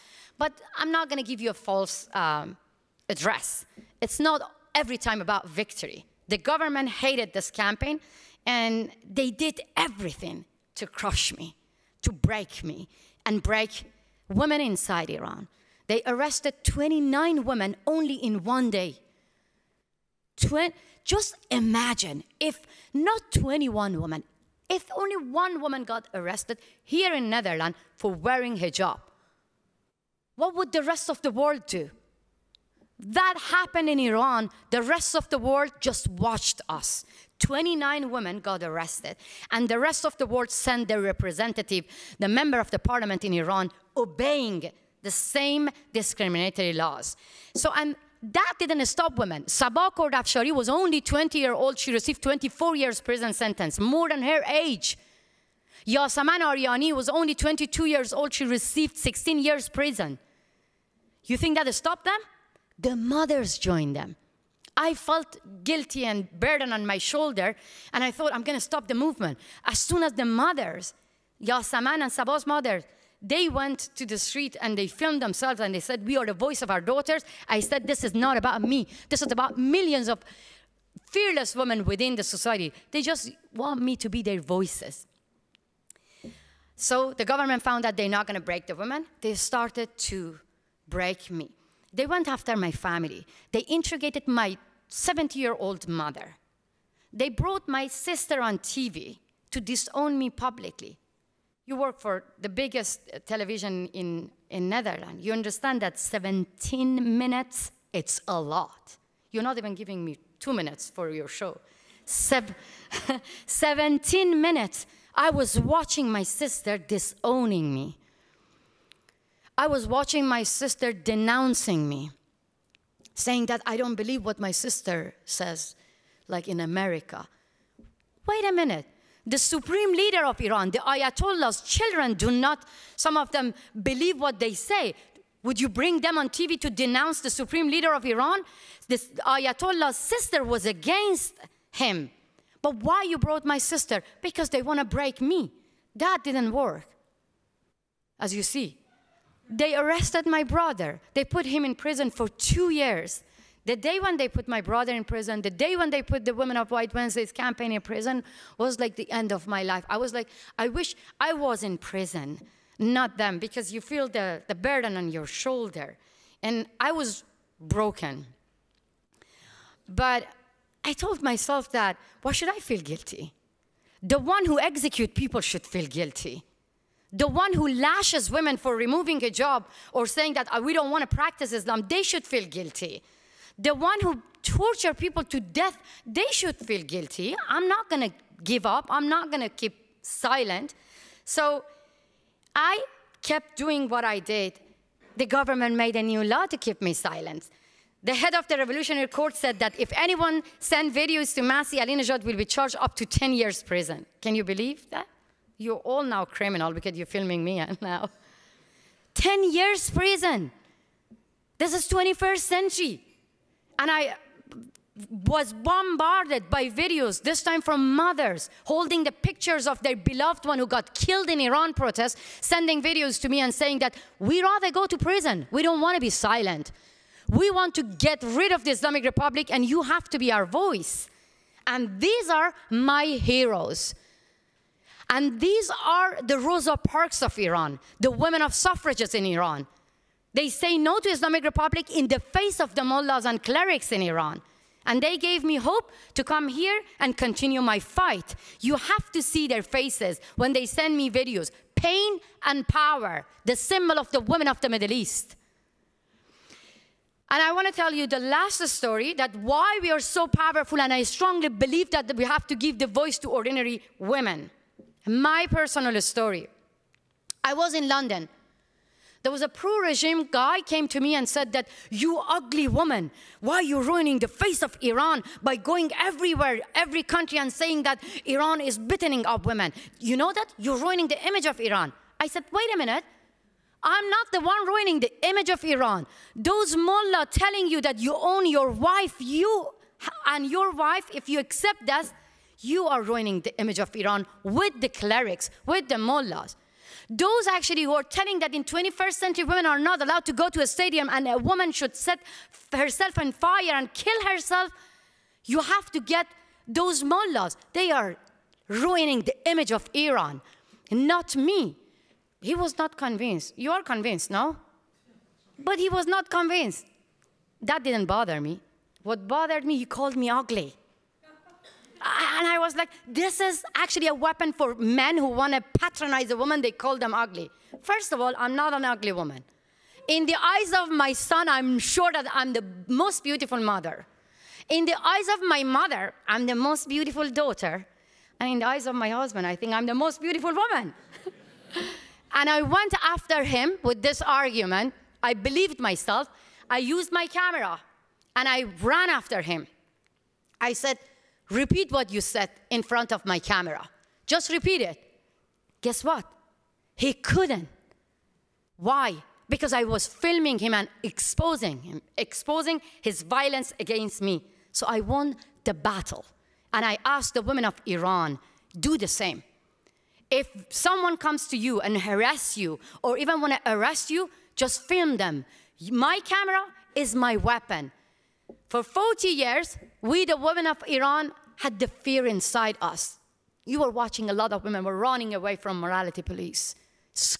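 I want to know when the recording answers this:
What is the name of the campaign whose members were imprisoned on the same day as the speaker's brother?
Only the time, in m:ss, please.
2:36.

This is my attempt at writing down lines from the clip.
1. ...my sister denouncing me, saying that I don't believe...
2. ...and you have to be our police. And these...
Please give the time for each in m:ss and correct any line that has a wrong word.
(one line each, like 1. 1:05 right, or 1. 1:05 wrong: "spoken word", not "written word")
1. 2:00 right
2. 3:49 wrong: "voice", not "police".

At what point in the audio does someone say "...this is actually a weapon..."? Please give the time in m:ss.
5:23.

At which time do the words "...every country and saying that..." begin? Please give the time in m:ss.
4:36.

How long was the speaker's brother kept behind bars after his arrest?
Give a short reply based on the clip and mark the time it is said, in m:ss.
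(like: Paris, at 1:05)
two years, at 2:32.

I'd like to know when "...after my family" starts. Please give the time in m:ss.
1:32.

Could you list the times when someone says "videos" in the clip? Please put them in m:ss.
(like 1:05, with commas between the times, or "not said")
3:20, 3:36, 3:42, 4:11.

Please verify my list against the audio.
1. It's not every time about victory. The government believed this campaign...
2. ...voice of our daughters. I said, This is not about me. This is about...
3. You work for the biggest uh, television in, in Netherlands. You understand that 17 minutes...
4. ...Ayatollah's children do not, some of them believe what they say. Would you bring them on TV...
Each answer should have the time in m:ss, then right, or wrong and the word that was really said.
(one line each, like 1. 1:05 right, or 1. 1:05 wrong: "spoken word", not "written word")
1. 0:03 wrong: "hated", not "believed"
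2. 1:16 right
3. 1:41 right
4. 2:10 right.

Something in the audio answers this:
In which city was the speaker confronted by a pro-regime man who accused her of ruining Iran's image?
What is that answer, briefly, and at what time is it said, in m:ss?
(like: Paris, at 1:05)
London, at 4:27.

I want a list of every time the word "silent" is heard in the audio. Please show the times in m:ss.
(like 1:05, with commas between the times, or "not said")
3:10, 3:16, 3:46.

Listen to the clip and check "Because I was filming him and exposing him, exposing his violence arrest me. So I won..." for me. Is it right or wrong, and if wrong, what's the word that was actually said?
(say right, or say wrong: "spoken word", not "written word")
wrong: "against", not "arrest".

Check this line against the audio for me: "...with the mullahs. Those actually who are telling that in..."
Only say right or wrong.
right.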